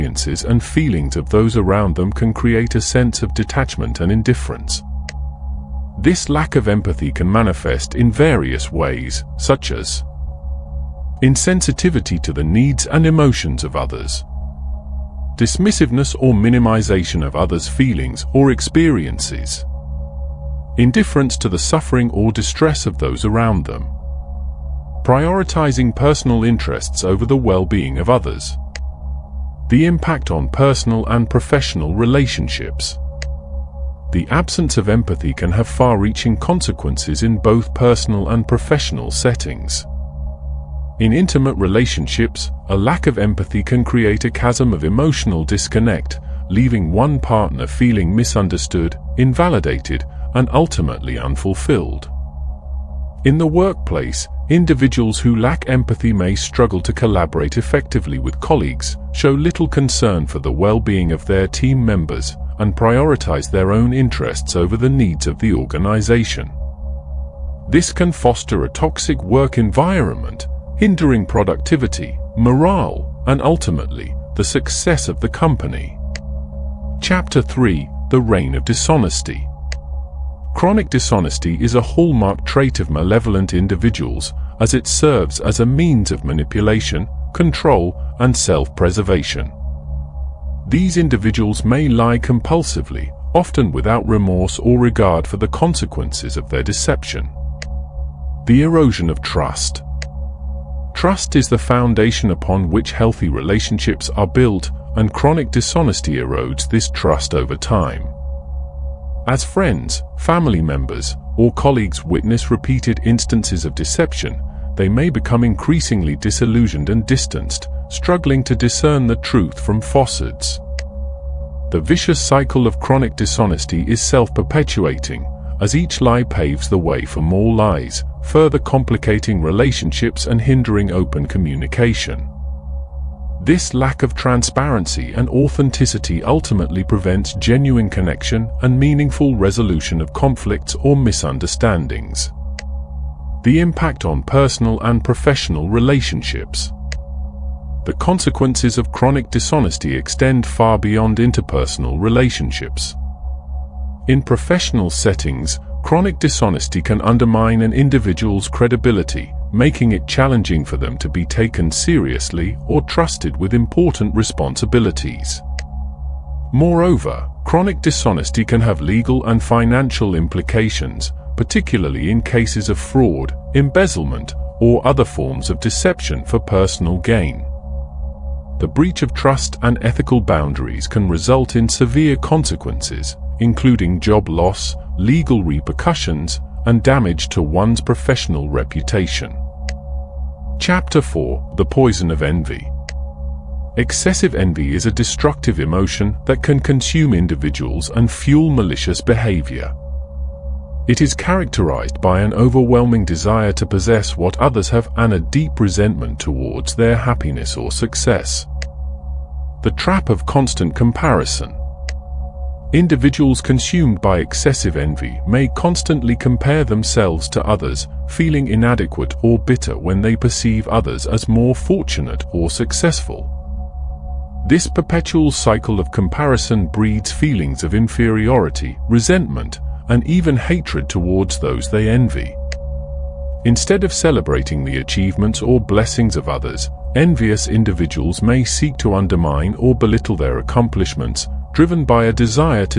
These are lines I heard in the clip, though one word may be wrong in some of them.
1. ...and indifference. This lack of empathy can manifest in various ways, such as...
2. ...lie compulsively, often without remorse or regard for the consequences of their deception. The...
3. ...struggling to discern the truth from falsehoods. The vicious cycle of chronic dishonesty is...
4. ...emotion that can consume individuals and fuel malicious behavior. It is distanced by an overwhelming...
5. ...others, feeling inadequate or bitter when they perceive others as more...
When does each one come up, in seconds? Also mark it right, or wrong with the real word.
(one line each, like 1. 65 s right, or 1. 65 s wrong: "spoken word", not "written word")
1. 4 s right
2. 91 s right
3. 117 s right
4. 195 s wrong: "characterized", not "distanced"
5. 217 s right.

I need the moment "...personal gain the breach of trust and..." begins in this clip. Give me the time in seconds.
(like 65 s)
176 s.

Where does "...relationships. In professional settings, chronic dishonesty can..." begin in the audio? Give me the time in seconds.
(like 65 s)
151 s.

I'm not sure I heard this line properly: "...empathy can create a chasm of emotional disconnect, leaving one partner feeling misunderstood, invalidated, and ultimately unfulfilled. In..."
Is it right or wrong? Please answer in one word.
right.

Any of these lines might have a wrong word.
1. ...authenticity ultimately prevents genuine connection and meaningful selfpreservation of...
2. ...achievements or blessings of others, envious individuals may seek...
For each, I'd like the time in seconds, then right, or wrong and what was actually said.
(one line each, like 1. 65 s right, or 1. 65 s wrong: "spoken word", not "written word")
1. 135 s wrong: "resolution", not "selfpreservation"
2. 234 s right.